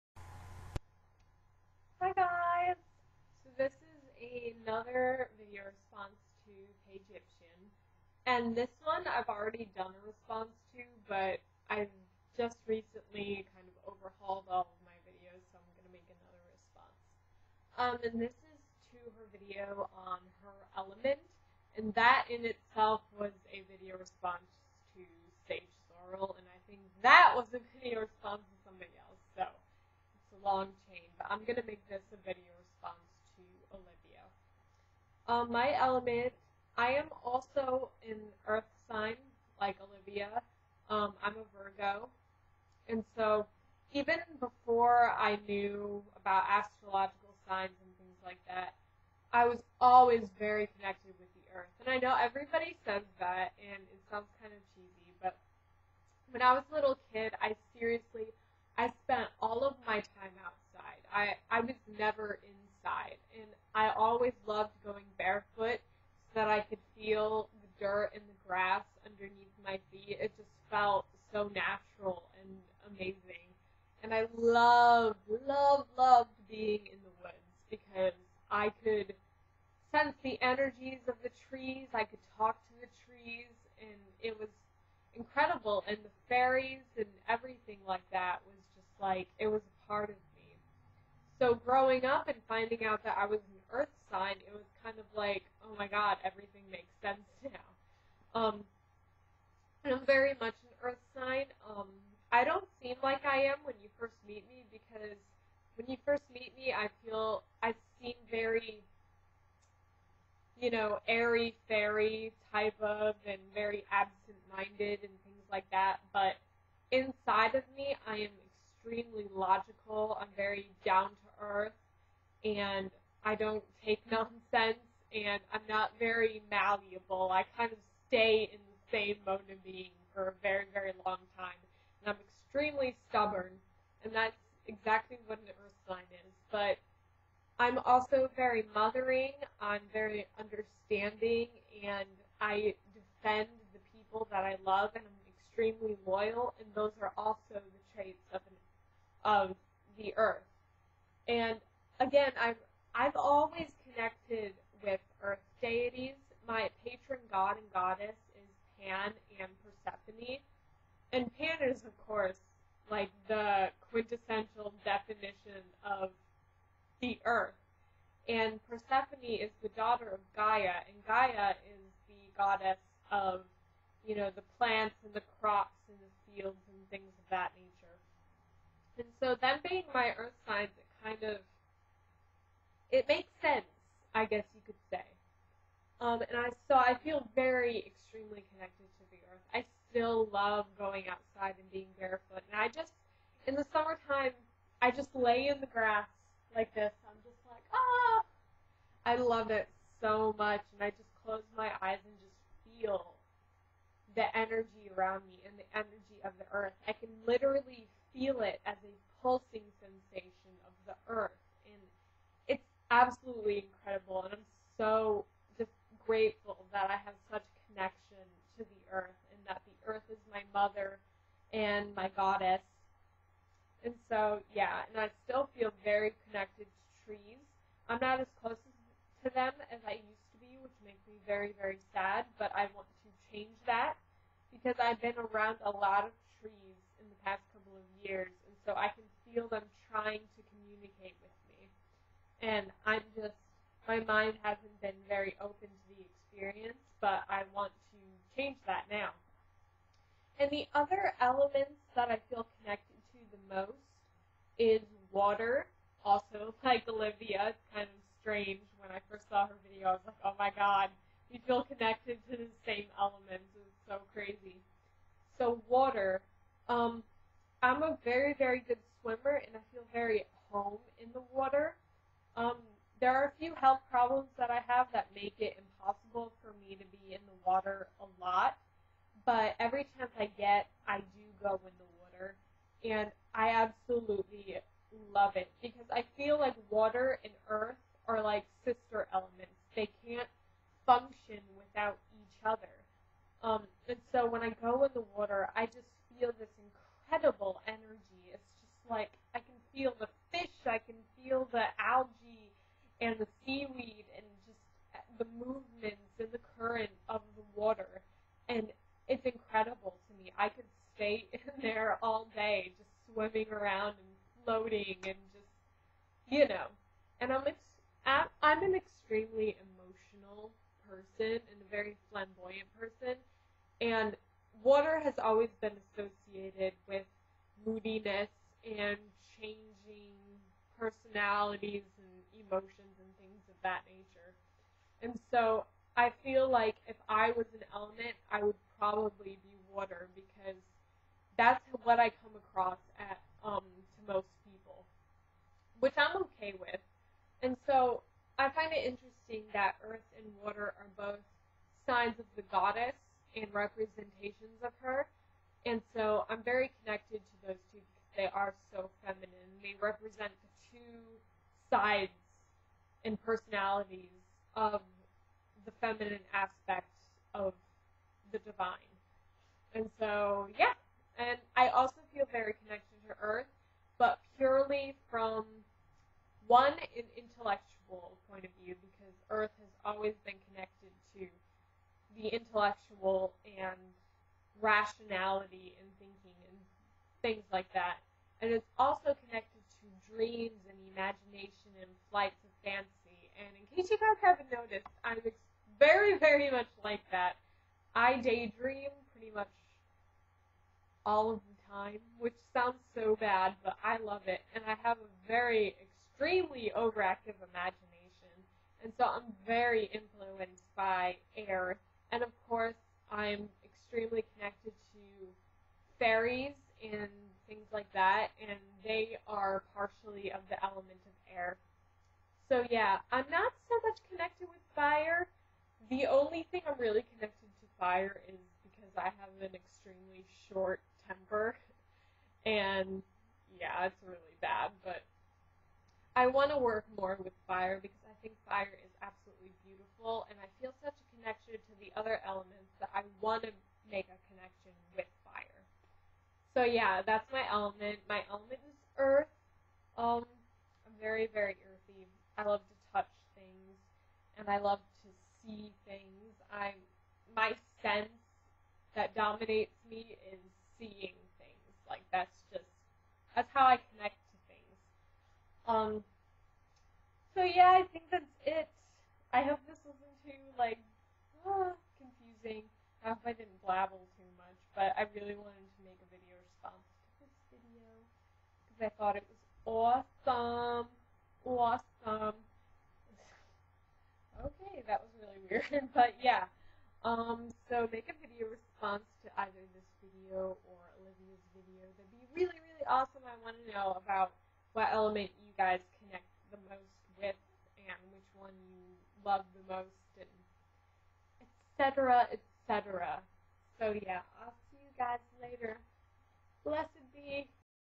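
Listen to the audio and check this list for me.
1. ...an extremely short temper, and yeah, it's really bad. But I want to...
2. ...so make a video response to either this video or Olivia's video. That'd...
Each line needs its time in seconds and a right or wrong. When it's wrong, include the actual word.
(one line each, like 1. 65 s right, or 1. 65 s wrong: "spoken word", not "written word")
1. 429 s right
2. 487 s right.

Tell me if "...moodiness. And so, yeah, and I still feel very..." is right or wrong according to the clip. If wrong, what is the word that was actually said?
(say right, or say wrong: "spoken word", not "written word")
wrong: "goddess", not "moodiness".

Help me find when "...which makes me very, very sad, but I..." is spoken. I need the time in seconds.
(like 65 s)
230 s.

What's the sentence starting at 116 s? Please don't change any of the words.
But inside of me, I am extremely logical.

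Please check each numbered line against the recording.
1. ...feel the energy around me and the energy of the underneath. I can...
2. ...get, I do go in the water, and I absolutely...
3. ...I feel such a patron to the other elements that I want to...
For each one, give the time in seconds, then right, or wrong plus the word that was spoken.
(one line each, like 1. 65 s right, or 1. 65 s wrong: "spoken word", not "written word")
1. 202 s wrong: "earth", not "underneath"
2. 280 s right
3. 440 s wrong: "connection", not "patron".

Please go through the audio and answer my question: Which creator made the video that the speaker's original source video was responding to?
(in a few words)
Sage Sorrel.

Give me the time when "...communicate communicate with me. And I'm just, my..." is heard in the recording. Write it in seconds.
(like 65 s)
240 s.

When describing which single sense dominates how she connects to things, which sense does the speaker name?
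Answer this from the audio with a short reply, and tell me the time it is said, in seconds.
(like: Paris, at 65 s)
seeing, at 460 s.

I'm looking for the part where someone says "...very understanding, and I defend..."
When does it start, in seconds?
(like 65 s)
139 s.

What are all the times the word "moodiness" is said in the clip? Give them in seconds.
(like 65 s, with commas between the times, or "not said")
327 s.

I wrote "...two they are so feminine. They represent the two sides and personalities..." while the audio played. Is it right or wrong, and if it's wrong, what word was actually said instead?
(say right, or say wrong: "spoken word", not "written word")
right.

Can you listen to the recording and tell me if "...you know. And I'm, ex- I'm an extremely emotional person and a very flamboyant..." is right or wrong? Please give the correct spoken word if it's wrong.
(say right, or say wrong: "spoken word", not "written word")
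right.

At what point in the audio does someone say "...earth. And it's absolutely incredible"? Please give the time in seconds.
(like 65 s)
211 s.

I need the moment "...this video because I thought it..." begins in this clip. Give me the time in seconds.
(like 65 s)
477 s.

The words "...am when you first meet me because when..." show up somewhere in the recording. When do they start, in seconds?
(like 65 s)
103 s.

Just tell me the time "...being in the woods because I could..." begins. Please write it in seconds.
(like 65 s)
76 s.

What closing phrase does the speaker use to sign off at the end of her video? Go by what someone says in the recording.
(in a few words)
Blessed be.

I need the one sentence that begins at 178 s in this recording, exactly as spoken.
And so them being my earth signs, it kind of it makes sense, I guess you could say.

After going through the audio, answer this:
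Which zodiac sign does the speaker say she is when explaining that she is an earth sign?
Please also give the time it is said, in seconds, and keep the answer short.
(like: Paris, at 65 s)
Virgo, at 41 s.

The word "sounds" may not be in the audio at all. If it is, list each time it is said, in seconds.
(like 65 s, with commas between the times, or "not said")
54 s, 402 s.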